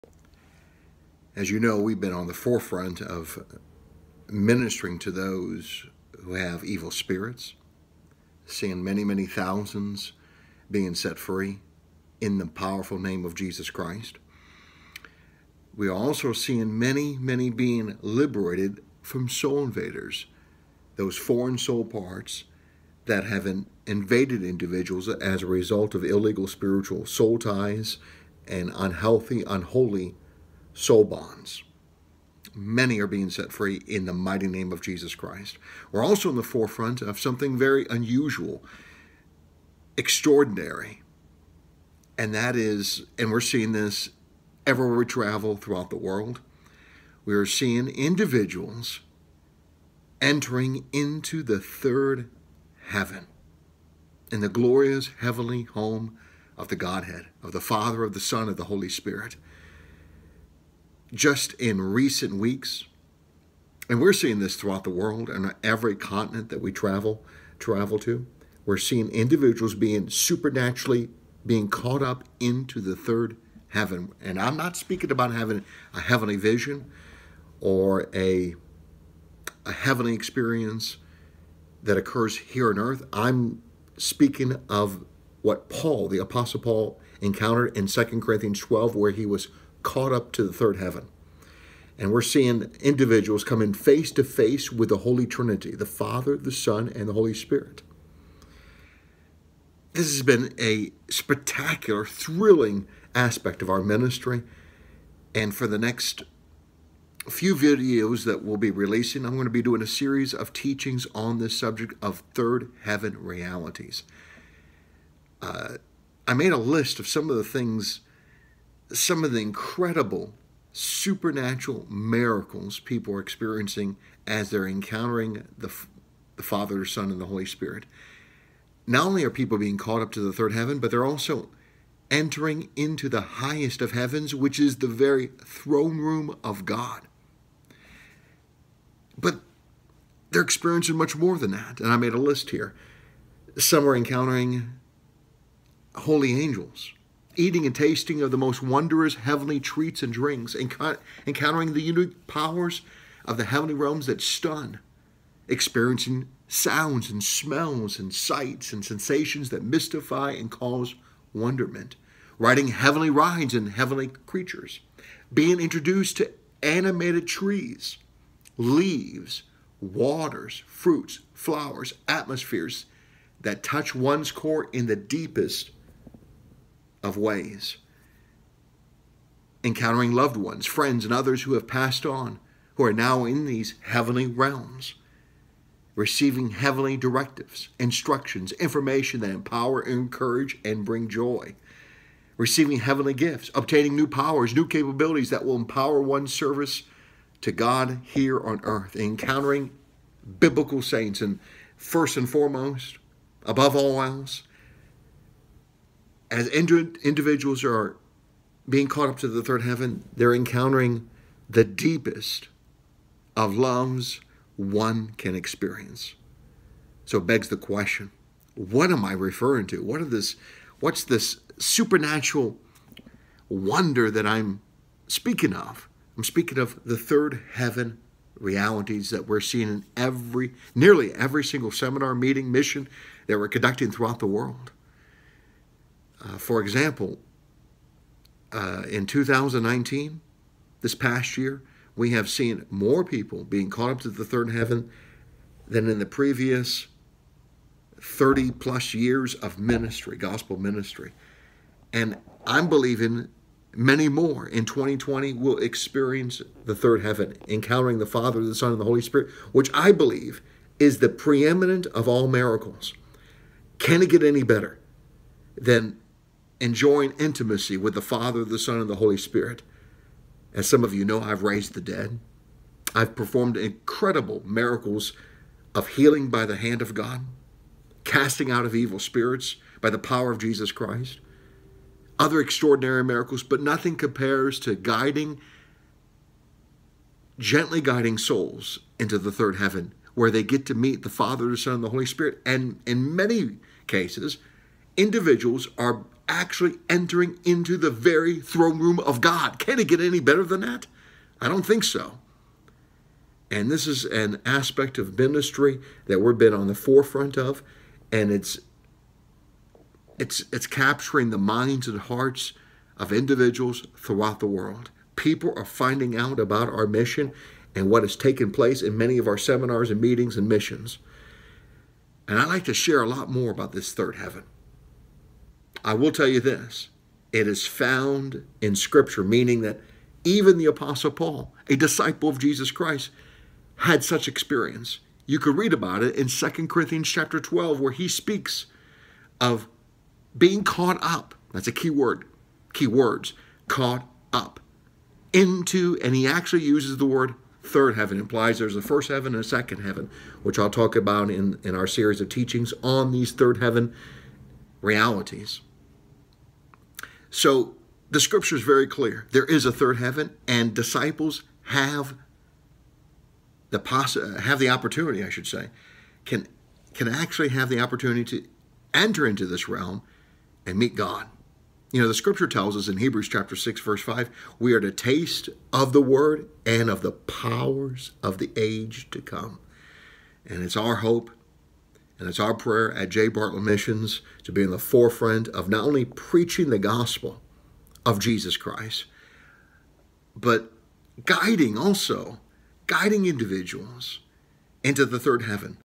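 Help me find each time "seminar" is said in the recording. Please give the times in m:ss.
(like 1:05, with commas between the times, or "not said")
3:51, 5:19.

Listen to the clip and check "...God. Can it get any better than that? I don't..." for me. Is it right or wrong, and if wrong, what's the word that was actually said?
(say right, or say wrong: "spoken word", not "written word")
right.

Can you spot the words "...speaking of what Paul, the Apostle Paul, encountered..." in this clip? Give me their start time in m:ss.
1:23.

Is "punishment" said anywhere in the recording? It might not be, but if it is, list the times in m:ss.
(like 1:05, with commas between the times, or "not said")
not said.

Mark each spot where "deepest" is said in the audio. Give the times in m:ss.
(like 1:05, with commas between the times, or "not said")
2:54, 3:31.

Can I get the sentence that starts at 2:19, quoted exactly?
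But they're experiencing much more than that.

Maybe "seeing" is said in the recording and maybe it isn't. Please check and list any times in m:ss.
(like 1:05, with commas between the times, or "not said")
0:08, 0:16, 0:43, 0:47, 1:04, 1:08, 1:32, 3:49.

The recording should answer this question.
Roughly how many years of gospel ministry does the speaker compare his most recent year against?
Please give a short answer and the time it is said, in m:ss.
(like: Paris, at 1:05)
30 plus, at 4:07.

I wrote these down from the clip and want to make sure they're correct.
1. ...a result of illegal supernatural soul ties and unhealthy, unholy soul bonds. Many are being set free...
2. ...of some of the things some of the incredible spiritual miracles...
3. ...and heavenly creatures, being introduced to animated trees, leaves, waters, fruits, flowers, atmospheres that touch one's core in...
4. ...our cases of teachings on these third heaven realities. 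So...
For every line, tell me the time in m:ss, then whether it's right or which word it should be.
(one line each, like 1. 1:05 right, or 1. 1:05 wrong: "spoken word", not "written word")
1. 0:25 wrong: "spiritual", not "supernatural"
2. 1:56 wrong: "supernatural", not "spiritual"
3. 2:43 right
4. 5:51 wrong: "series", not "cases".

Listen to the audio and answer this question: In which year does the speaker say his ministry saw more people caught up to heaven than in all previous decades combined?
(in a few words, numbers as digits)
2019.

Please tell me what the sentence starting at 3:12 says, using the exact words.
Receiving heavenly gifts, obtaining new powers, new capabilities that will empower one's service to God here on earth.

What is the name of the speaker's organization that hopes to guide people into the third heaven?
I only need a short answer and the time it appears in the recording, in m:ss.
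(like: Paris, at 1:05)
Jay Bartlett Missions, at 6:23.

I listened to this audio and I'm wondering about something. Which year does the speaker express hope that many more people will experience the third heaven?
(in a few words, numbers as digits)
2020.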